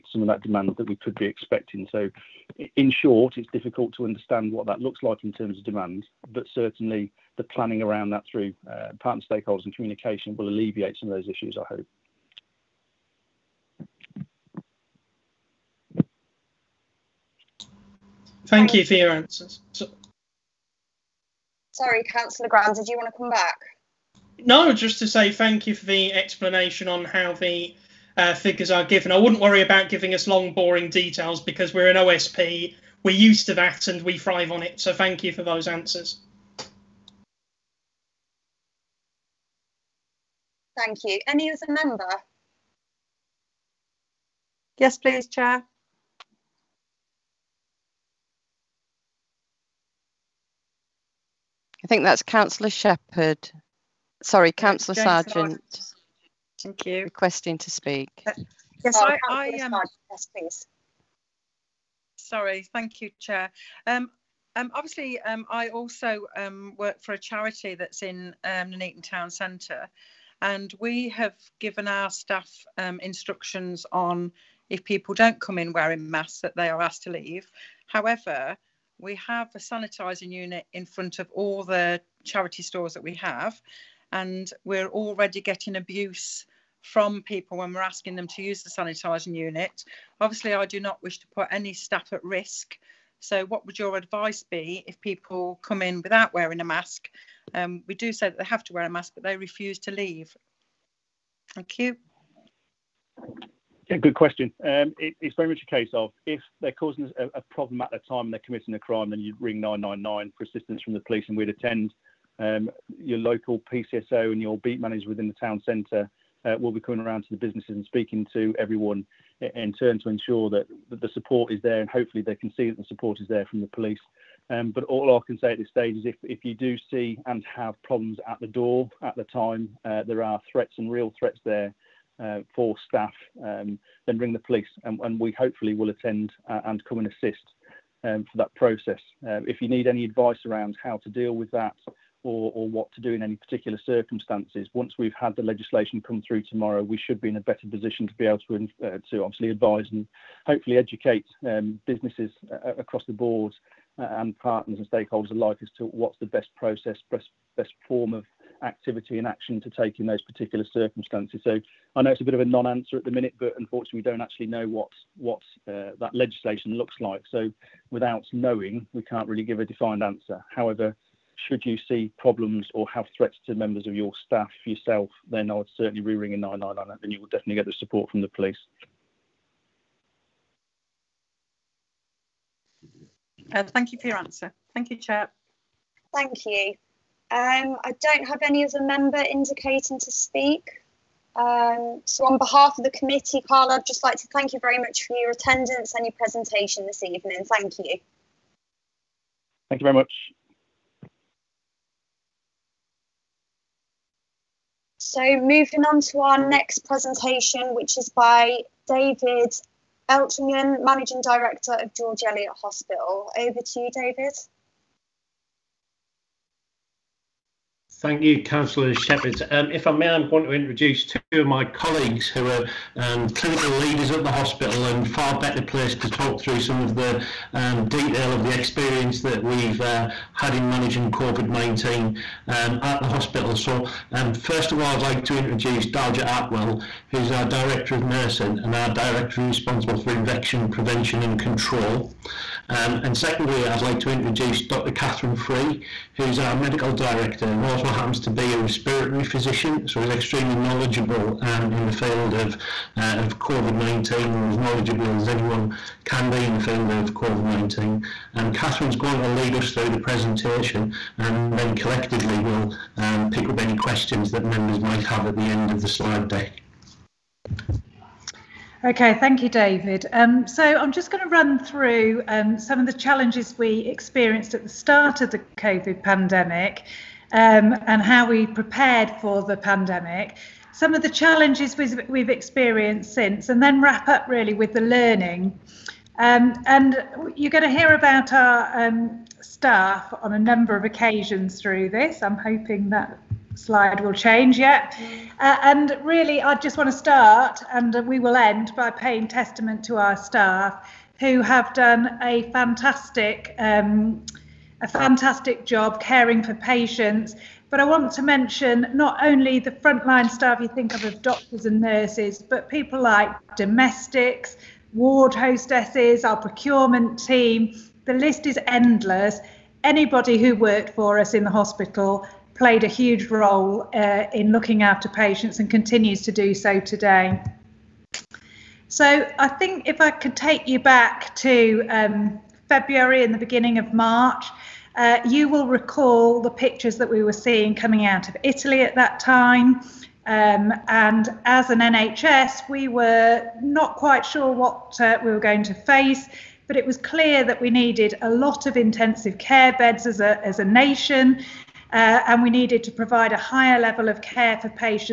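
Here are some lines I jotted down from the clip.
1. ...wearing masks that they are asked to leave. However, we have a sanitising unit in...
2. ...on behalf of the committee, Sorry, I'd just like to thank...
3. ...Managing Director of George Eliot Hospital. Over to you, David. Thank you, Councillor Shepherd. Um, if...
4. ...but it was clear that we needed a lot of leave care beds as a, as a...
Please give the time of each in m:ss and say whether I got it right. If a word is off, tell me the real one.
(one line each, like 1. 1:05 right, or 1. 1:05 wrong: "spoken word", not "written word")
1. 1:15 right
2. 3:12 wrong: "Carla", not "Sorry"
3. 3:30 right
4. 5:46 wrong: "intensive", not "leave".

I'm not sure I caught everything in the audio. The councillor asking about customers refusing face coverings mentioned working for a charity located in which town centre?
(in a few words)
Nuneaton.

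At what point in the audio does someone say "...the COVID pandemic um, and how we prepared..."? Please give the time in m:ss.
4:35.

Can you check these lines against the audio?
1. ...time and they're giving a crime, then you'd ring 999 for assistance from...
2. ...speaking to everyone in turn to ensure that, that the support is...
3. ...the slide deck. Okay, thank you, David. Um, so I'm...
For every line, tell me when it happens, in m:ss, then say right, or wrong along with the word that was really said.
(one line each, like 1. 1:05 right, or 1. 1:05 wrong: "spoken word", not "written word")
1. 1:47 wrong: "committing", not "giving"
2. 1:57 right
3. 4:25 right.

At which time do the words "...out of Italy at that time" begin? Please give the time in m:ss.
5:38.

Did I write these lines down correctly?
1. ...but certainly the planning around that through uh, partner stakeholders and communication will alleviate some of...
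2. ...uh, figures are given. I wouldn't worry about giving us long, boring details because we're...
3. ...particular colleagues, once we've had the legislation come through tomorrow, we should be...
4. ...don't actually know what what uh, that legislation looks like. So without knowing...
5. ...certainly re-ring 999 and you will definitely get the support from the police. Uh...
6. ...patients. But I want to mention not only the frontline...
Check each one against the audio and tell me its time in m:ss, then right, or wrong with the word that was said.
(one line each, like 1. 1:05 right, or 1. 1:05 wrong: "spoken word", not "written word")
1. 0:06 right
2. 0:28 right
3. 2:23 wrong: "circumstances", not "colleagues"
4. 2:44 right
5. 2:55 right
6. 5:06 right.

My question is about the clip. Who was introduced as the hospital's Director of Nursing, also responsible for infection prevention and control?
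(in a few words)
Daljit Atwell.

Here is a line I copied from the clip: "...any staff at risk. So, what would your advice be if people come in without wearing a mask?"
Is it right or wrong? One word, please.
right.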